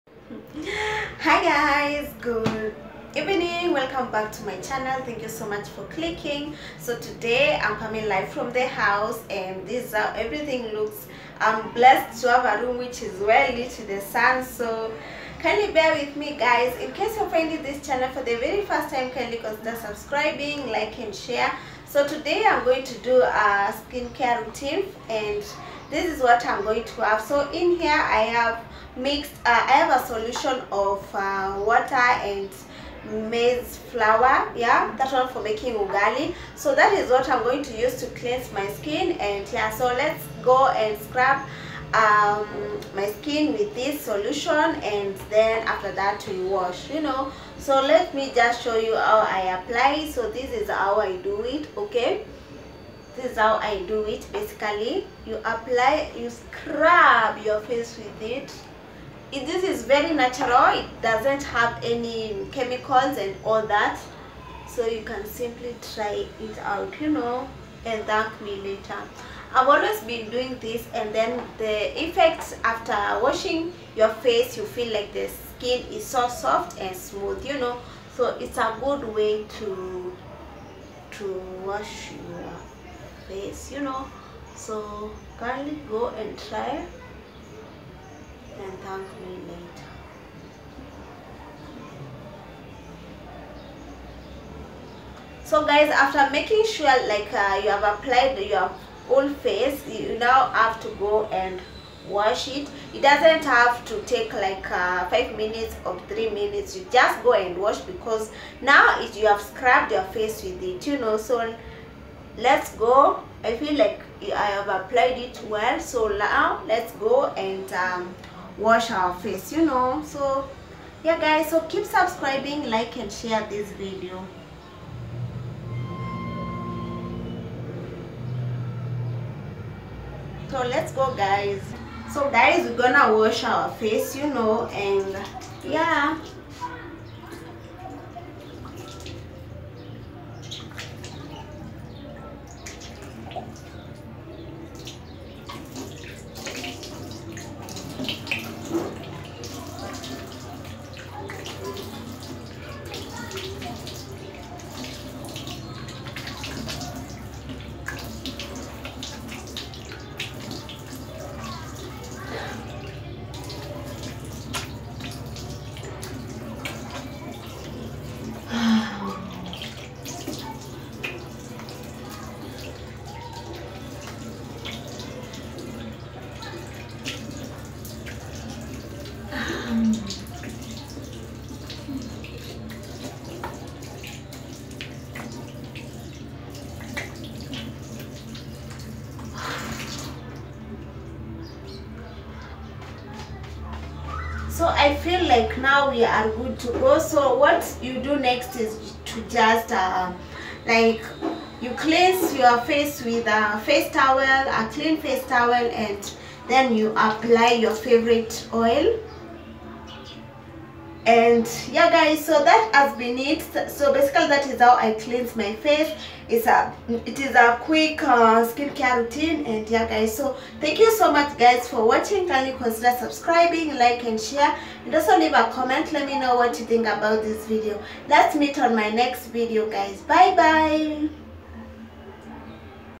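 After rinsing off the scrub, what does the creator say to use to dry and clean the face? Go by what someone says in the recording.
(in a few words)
clean face towel.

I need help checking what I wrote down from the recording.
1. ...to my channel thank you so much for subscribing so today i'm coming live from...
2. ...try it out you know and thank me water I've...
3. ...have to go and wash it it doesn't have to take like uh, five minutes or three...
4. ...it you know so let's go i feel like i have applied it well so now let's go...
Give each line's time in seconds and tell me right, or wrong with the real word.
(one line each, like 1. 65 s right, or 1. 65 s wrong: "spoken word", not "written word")
1. 4 s wrong: "clicking", not "subscribing"
2. 65 s wrong: "later", not "water"
3. 100 s right
4. 110 s right.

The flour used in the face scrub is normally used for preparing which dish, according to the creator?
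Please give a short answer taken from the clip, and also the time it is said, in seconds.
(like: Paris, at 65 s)
ugali, at 35 s.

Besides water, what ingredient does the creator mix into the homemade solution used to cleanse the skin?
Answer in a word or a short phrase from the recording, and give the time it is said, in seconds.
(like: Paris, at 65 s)
maize flour, at 33 s.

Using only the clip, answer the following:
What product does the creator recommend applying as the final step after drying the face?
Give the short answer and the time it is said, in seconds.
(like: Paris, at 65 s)
favorite oil, at 207 s.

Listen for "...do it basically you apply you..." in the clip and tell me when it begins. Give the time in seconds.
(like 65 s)
53 s.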